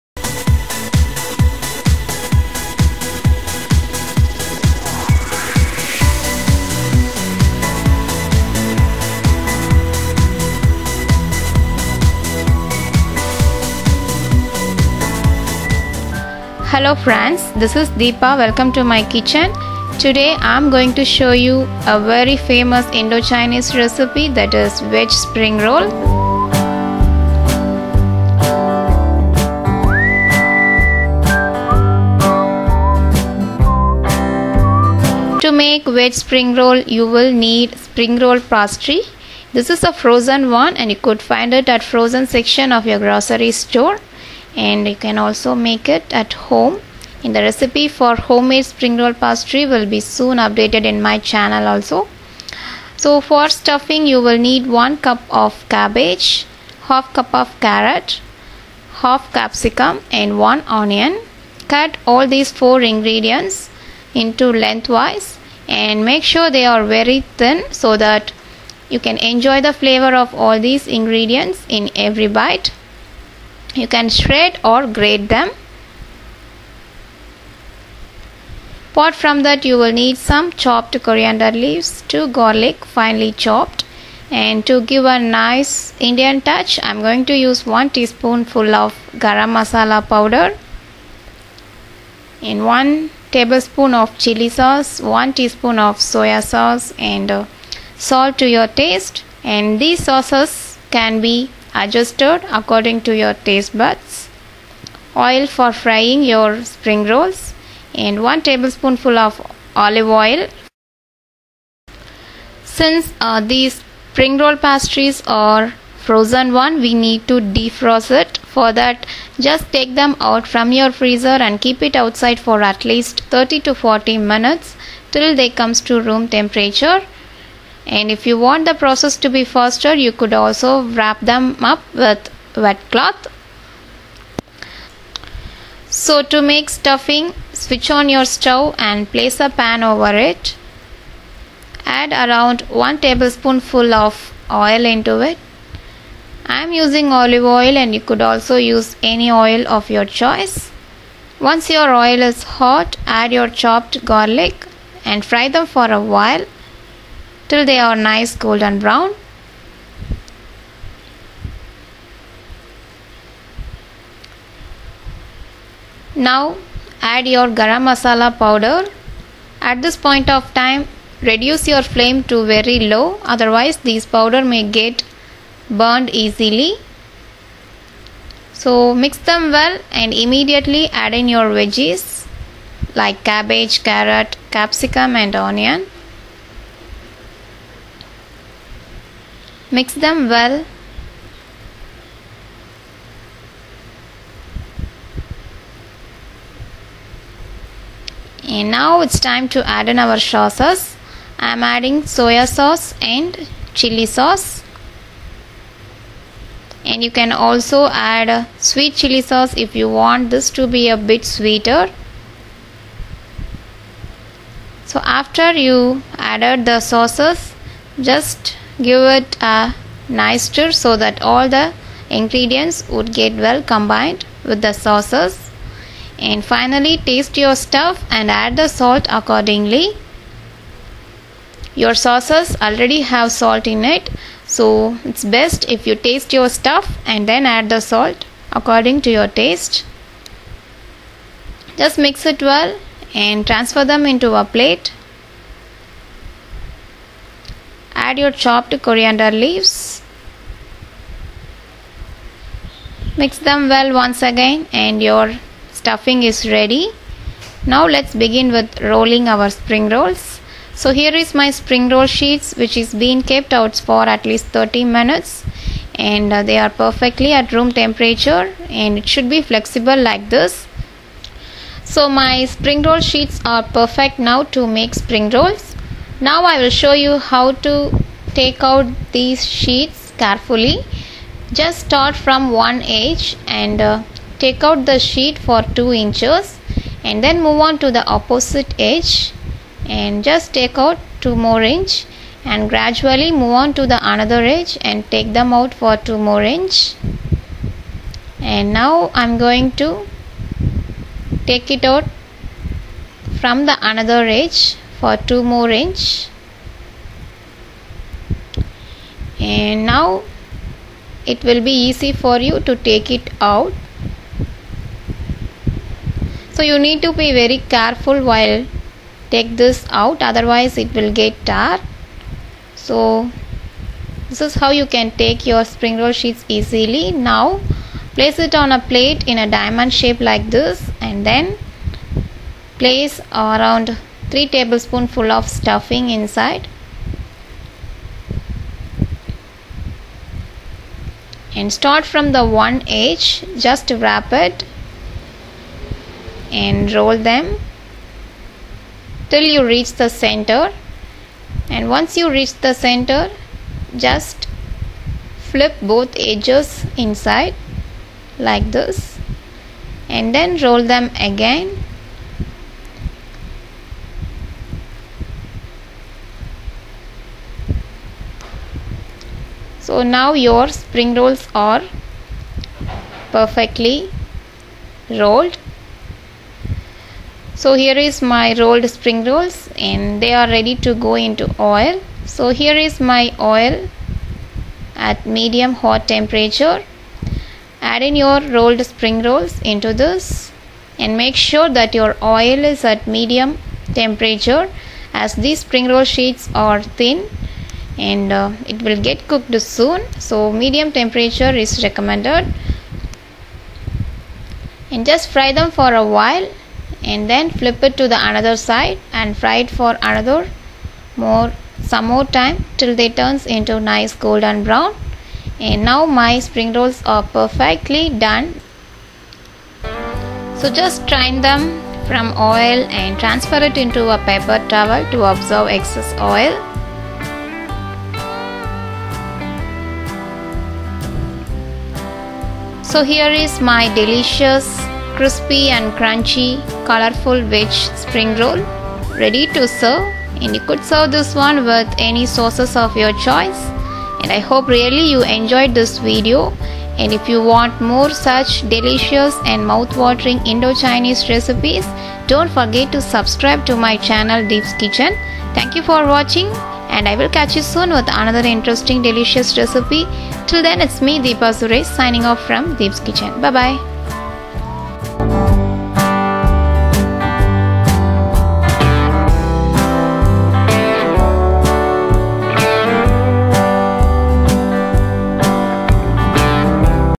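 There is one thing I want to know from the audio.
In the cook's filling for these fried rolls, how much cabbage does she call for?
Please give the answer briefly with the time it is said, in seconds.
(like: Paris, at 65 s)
1 cup, at 54 s.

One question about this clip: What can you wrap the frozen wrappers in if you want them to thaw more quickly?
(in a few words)
wet cloth.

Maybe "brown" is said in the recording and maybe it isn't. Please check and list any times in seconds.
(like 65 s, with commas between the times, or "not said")
158 s, 414 s.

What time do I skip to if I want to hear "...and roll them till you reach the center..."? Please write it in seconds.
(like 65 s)
346 s.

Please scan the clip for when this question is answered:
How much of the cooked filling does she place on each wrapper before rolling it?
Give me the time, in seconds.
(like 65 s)
334 s.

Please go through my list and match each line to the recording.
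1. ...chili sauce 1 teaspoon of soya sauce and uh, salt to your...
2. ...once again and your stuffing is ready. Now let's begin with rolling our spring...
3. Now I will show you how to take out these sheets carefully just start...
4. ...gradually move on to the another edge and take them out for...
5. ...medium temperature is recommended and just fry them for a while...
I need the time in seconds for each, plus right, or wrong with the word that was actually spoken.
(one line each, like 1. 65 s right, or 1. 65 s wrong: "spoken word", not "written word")
1. 94 s right
2. 253 s right
3. 276 s right
4. 292 s right
5. 400 s right.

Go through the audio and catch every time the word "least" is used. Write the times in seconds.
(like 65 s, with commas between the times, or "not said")
122 s, 264 s.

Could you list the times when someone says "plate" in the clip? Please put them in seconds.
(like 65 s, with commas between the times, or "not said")
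244 s, 328 s.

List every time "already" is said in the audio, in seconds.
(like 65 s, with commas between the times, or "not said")
232 s.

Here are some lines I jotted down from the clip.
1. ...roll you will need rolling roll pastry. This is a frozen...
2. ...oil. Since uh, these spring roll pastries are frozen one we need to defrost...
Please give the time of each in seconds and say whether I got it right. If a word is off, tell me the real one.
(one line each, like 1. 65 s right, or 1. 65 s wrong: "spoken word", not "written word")
1. 36 s wrong: "spring", not "rolling"
2. 110 s right.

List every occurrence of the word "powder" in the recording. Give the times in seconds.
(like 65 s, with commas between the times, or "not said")
90 s, 168 s, 174 s.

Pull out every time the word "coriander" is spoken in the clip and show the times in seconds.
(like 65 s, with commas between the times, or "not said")
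81 s, 248 s.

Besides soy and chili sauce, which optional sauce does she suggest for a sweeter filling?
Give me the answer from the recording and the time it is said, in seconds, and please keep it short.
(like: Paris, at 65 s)
sweet chili sauce, at 208 s.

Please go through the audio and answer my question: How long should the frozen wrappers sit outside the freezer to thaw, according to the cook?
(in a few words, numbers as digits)
30 to 40 minutes.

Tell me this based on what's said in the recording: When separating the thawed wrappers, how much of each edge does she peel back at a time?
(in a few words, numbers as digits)
2 inches.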